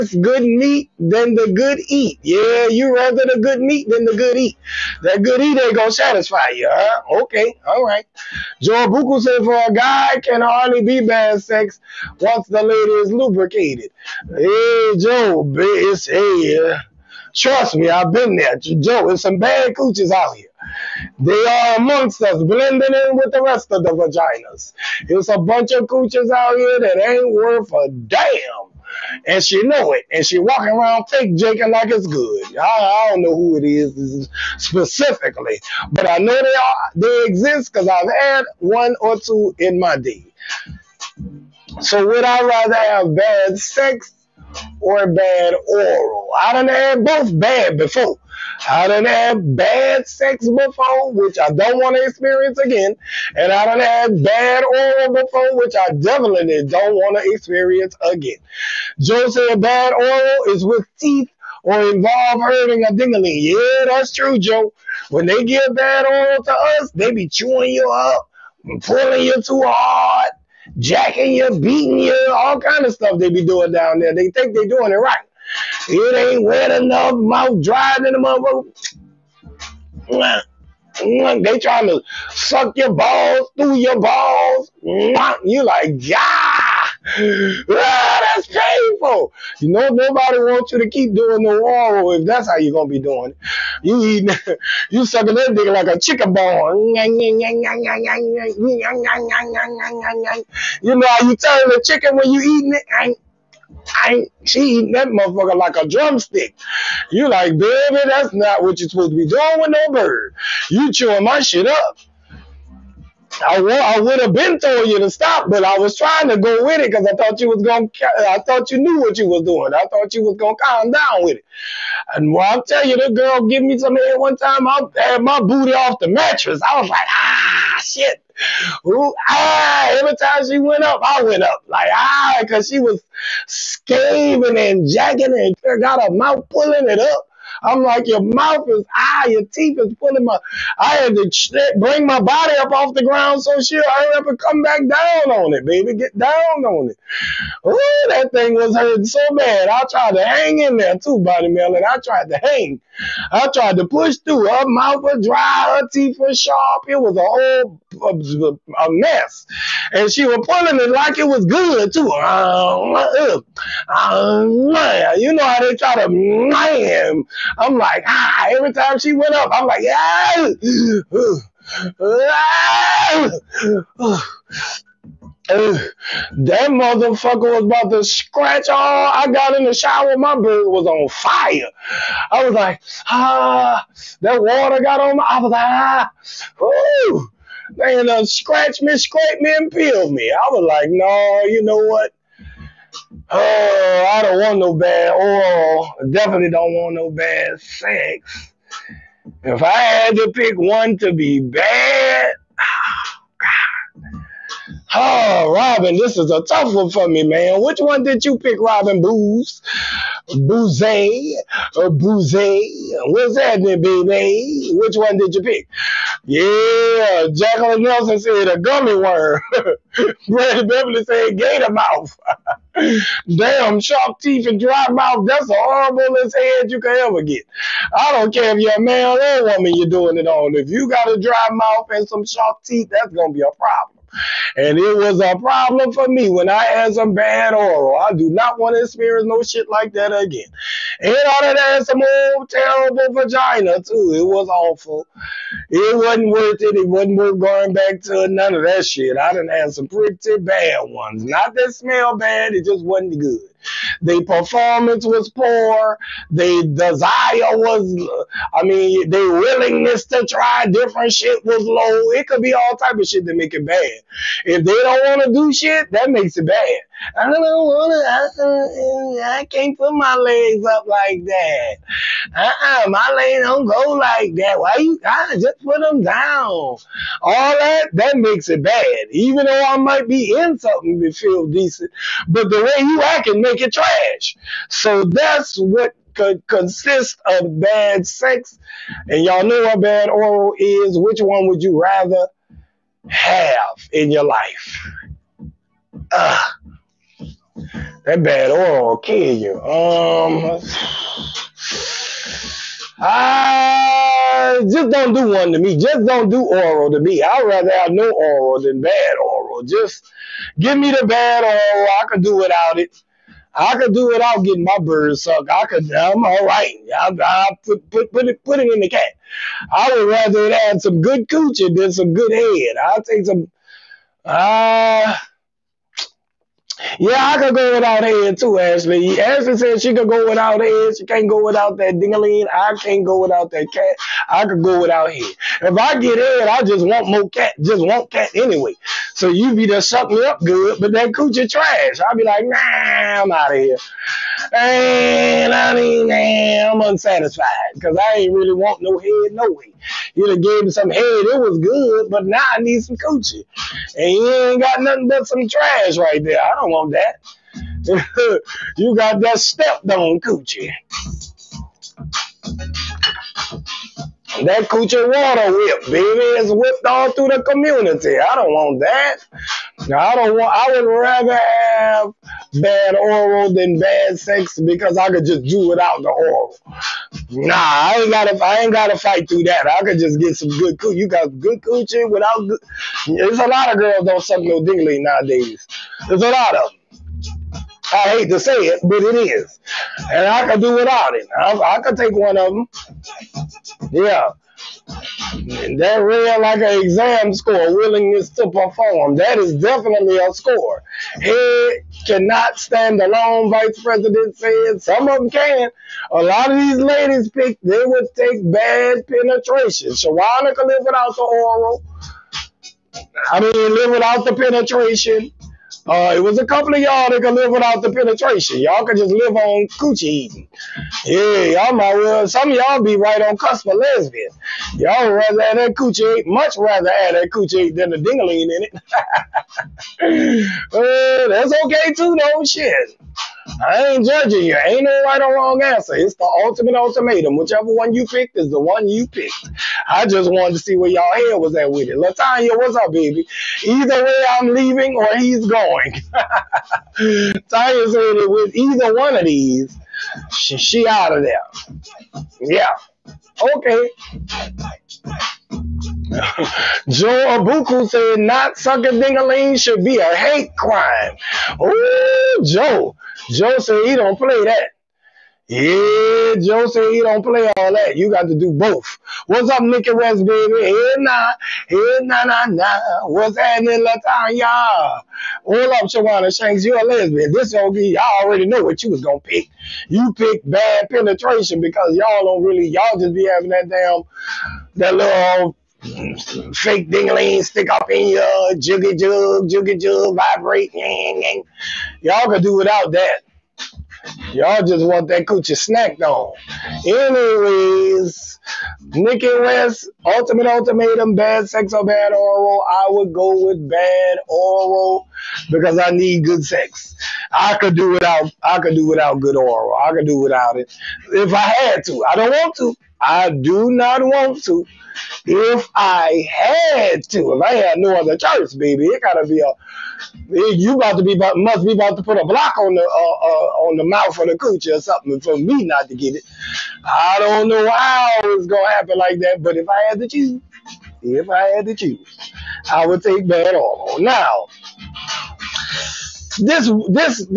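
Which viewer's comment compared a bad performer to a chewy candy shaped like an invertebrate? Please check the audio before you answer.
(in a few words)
Jacqueline Nelson.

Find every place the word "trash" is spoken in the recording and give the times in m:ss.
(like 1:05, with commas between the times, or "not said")
4:43, 5:41, 5:55.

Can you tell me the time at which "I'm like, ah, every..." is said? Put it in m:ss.
2:47.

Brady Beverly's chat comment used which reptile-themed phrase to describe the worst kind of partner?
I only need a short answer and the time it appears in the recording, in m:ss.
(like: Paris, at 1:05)
gator mouth, at 3:41.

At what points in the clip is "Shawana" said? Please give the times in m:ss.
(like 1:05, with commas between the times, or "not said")
6:49, 7:55.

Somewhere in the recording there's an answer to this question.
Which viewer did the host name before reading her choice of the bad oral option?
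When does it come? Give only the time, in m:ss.
8:18.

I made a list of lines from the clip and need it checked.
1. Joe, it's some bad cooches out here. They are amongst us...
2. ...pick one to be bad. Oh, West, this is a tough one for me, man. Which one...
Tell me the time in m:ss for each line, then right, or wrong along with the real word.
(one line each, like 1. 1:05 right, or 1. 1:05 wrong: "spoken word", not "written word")
1. 0:18 right
2. 3:20 wrong: "Robin", not "West".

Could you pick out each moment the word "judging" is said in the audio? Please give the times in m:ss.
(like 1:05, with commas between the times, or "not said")
7:14.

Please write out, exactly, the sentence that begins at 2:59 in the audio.
I got in the shower, my bird was on fire.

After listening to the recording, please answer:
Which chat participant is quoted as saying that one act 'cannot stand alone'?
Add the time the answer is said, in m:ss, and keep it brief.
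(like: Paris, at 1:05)
Vice President, at 6:43.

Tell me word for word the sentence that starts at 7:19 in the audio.
I just wanted to see where y'all head was at with it.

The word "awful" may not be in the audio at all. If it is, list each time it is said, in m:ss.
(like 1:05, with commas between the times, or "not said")
4:04.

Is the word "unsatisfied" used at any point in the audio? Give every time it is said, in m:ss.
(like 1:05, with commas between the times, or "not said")
5:46.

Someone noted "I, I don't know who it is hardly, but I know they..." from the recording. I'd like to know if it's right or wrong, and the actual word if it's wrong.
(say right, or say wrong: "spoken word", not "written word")
wrong: "specifically", not "hardly".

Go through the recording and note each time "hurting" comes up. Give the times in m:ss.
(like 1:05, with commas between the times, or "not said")
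1:02, 2:28.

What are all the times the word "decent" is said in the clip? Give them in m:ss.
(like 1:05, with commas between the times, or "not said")
4:41.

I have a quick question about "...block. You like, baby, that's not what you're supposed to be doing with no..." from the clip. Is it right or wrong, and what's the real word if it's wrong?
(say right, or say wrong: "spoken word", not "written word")
wrong: "drumstick", not "block".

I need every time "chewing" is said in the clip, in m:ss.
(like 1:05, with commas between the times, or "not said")
1:07, 1:50.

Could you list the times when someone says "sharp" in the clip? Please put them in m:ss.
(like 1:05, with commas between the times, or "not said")
2:36, 3:43, 3:52.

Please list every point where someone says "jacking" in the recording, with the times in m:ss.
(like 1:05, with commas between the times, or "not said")
1:10, 2:14.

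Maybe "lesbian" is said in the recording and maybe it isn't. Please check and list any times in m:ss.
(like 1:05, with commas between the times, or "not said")
7:03, 7:56.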